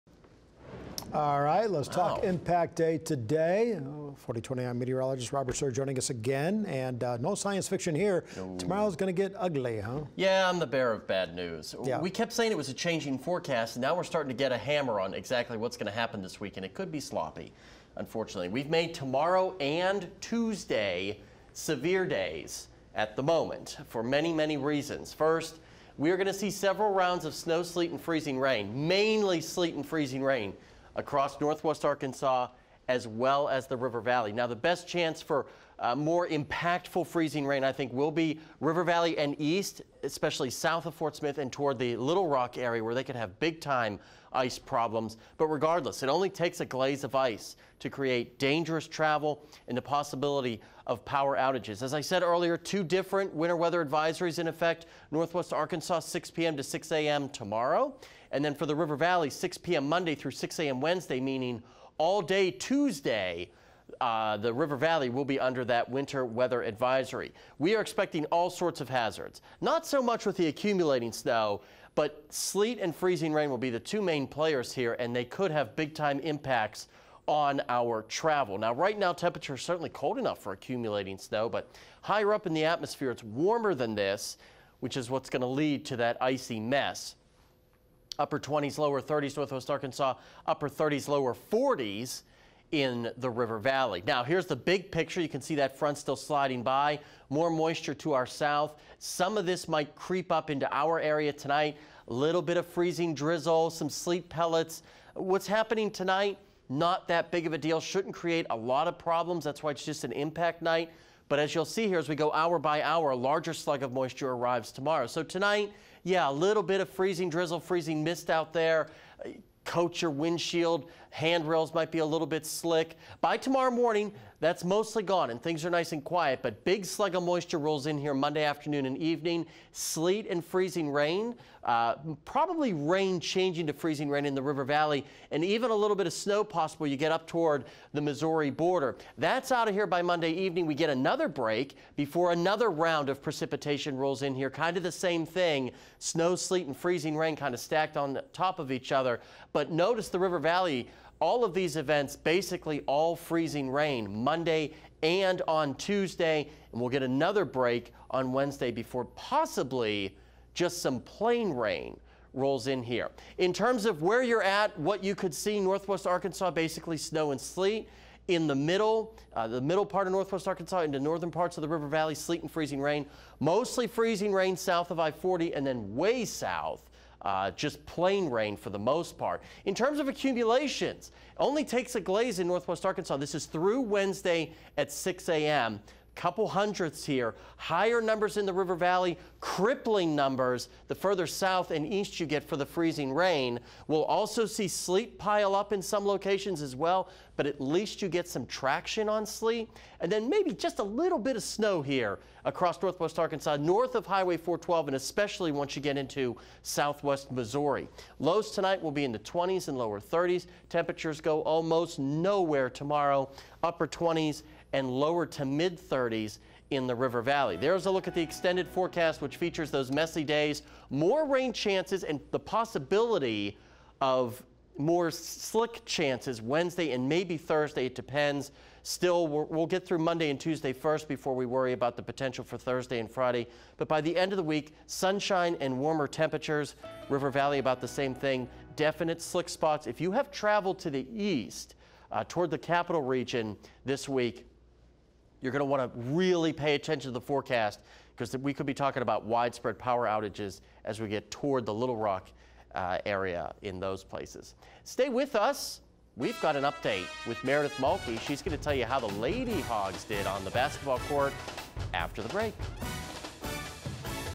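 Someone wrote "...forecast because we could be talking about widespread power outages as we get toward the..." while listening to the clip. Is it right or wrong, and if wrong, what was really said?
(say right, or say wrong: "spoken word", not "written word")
right.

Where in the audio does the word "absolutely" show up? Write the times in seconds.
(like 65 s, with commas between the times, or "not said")
not said.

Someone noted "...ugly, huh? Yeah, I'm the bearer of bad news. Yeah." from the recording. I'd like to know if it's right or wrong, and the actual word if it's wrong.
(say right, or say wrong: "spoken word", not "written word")
right.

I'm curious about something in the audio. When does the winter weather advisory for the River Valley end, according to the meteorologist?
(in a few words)
6 a.m. Wednesday.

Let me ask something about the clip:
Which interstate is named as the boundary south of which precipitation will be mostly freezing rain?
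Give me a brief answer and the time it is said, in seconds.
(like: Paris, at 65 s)
I-40, at 175 s.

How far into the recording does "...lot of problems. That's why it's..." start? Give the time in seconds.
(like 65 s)
108 s.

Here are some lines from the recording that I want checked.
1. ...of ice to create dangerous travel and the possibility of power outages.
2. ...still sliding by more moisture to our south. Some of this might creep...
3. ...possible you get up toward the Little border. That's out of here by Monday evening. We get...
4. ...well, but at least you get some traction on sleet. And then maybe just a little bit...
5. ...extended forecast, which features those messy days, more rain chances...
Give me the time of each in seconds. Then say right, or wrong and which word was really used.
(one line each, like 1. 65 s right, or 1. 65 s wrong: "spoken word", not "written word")
1. 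47 s right
2. 95 s right
3. 136 s wrong: "Missouri", not "Little"
4. 196 s right
5. 218 s right.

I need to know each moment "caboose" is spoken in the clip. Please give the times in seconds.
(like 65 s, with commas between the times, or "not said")
not said.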